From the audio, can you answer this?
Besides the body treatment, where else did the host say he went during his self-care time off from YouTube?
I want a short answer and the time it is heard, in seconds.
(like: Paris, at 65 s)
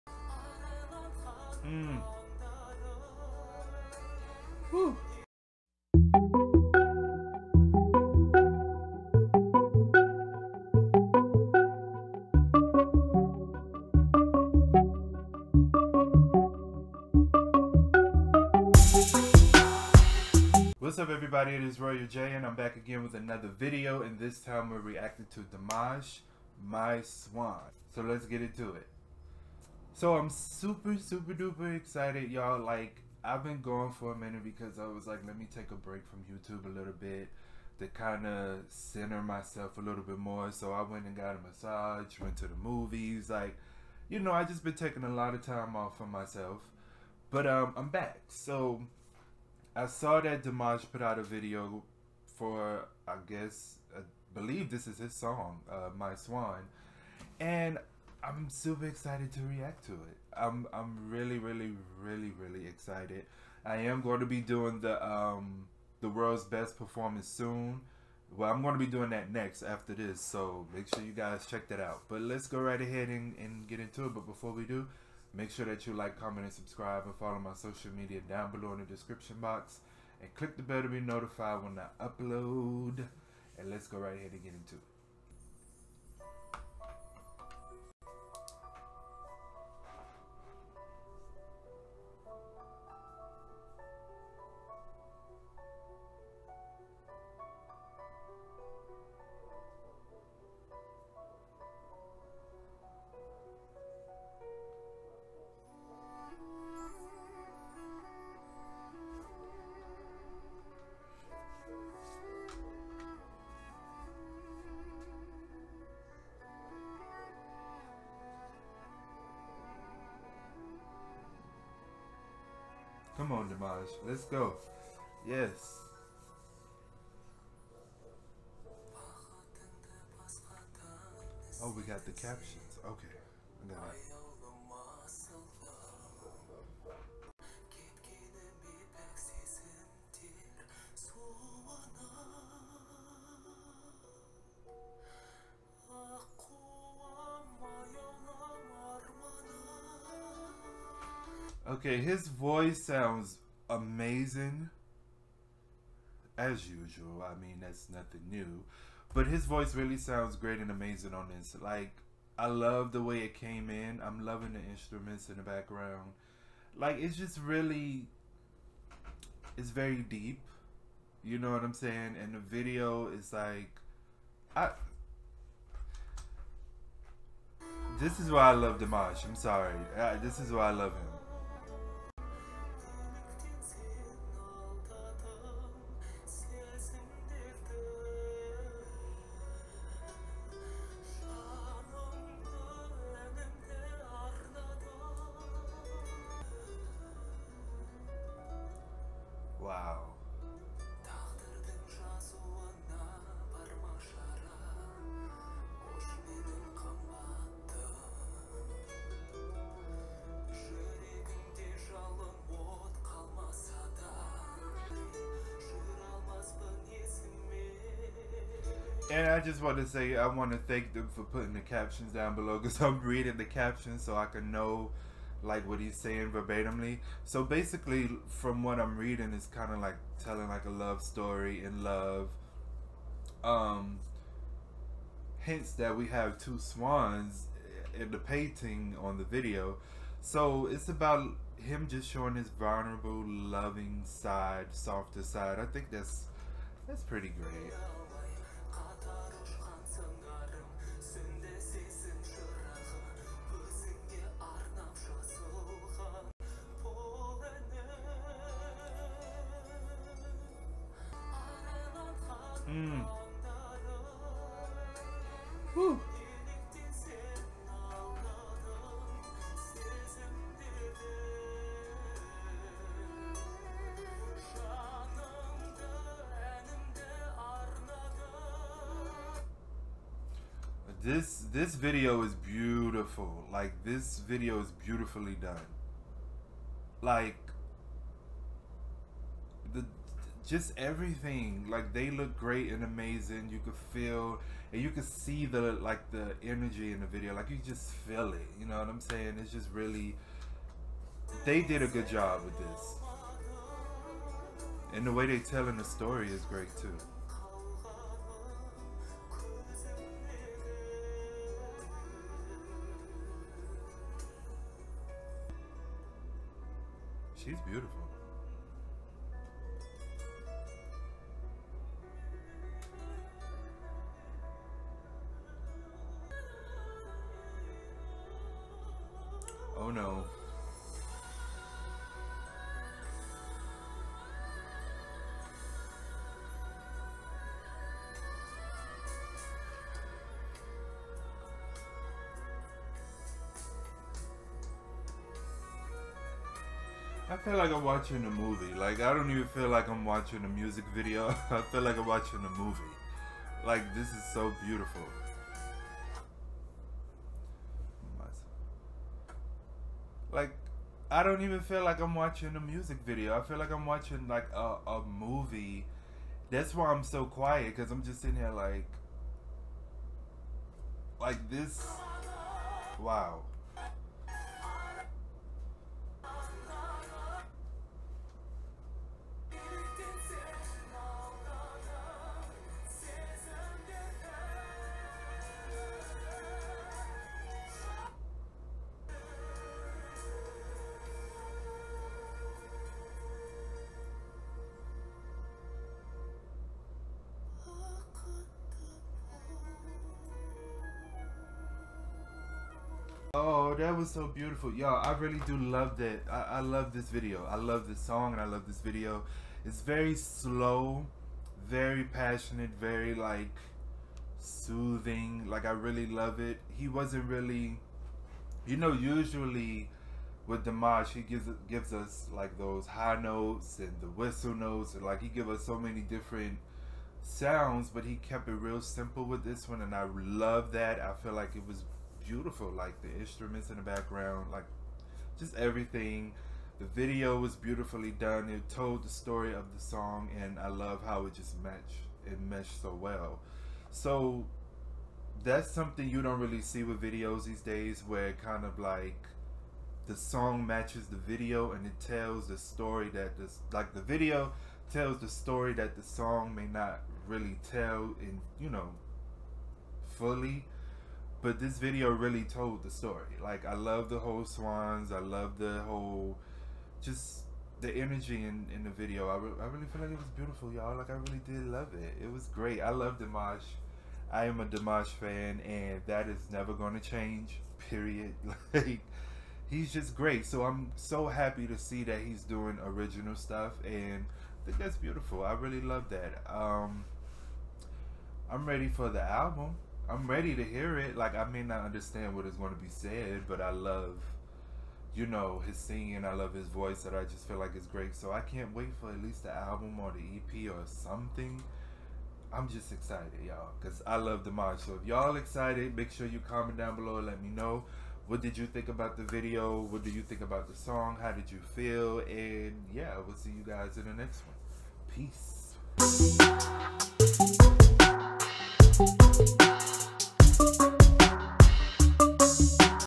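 The movies, at 42 s.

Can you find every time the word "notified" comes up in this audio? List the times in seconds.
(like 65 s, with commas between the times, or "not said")
81 s.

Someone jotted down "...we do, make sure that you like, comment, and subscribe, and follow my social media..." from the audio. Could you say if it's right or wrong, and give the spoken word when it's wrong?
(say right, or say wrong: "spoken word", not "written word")
right.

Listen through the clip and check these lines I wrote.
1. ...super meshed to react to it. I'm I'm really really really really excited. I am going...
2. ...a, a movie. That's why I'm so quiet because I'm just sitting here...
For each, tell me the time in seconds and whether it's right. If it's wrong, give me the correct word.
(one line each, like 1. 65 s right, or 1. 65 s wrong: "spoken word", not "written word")
1. 58 s wrong: "excited", not "meshed"
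2. 364 s right.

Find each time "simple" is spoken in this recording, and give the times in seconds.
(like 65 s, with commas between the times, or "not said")
428 s.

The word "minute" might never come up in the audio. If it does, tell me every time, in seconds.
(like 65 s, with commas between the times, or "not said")
34 s.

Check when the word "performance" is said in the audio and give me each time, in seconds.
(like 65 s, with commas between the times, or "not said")
66 s.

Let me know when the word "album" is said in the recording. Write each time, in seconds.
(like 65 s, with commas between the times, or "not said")
489 s, 499 s.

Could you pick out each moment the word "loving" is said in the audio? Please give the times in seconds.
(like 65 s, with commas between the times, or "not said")
164 s, 243 s.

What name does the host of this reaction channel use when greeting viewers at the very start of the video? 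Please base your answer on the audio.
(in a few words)
Royal J.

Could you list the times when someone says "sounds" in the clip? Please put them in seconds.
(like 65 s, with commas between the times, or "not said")
152 s, 159 s, 427 s.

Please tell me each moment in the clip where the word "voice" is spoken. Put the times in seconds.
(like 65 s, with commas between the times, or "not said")
152 s, 159 s, 496 s.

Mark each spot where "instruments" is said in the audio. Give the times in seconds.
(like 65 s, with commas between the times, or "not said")
164 s, 433 s.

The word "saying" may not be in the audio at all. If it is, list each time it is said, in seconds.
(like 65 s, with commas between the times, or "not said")
171 s, 226 s, 298 s.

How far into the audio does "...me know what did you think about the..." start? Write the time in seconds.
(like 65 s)
507 s.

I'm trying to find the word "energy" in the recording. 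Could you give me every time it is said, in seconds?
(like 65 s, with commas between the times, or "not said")
296 s, 467 s.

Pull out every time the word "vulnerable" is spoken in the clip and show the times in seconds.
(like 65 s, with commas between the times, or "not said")
242 s.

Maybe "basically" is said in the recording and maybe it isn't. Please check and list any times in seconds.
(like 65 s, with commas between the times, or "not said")
227 s.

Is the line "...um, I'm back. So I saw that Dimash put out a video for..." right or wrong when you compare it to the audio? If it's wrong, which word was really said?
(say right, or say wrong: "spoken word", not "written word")
right.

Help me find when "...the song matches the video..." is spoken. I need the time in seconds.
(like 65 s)
450 s.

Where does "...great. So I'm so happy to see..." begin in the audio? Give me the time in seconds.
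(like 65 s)
480 s.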